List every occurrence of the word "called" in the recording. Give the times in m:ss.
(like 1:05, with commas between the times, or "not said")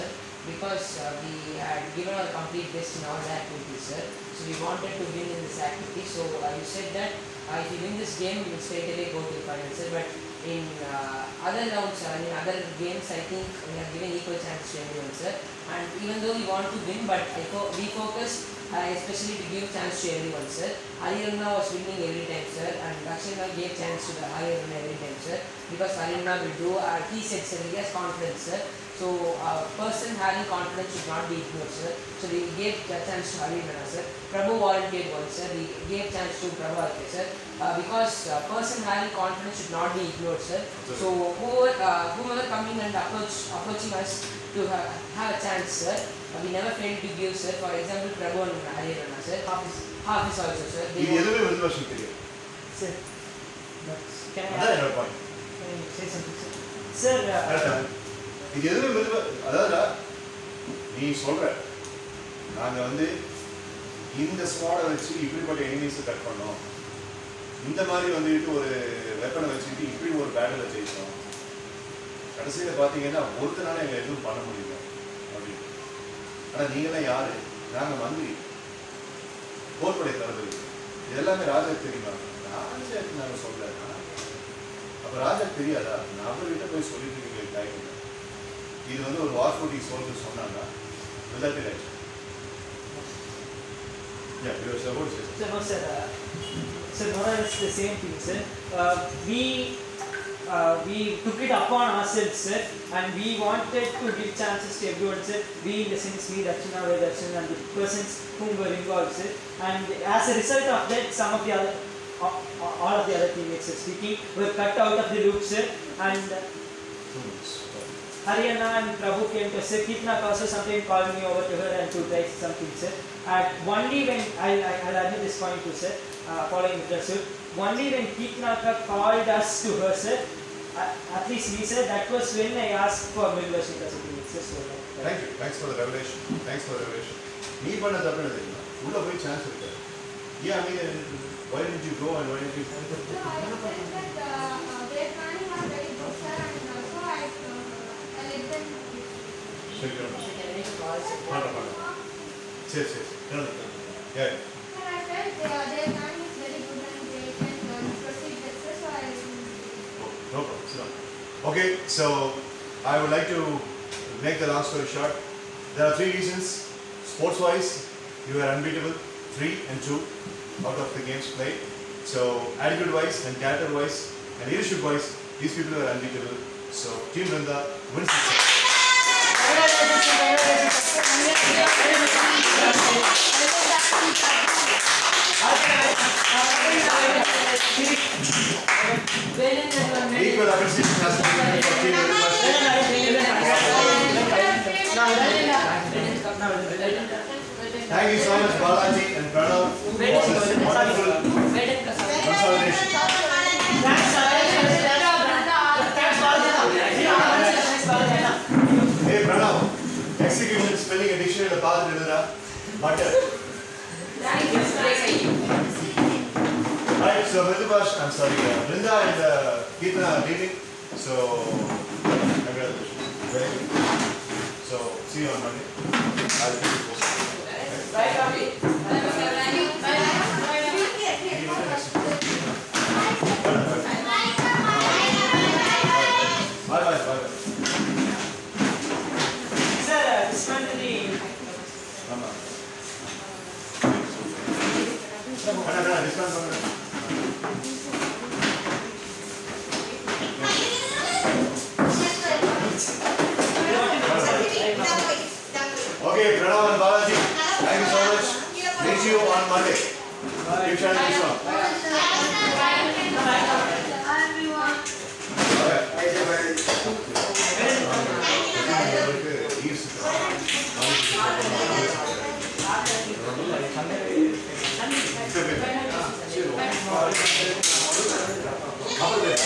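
2:00, 2:08.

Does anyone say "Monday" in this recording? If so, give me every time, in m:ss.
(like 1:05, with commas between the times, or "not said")
3:45, 4:19.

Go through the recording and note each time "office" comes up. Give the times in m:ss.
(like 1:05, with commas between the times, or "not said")
not said.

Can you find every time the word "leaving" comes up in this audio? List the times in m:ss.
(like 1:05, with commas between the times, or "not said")
3:40.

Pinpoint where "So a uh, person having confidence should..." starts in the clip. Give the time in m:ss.
0:28.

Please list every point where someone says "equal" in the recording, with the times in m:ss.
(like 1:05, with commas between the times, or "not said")
0:14.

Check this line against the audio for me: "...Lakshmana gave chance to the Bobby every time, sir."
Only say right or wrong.
wrong.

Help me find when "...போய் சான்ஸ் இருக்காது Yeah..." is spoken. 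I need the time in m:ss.
2:19.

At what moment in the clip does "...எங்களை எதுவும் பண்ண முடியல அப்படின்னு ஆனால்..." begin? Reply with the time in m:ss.
1:13.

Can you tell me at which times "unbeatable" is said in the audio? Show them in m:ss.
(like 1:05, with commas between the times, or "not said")
2:48, 2:55.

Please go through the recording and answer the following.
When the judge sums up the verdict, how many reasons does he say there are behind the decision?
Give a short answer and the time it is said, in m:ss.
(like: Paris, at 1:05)
3, at 2:45.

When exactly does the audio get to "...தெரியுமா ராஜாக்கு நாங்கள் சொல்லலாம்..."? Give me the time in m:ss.
1:21.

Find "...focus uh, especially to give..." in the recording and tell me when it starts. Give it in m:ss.
0:17.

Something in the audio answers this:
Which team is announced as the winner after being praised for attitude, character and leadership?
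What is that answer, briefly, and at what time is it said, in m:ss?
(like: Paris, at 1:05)
Team Vrinda, at 2:57.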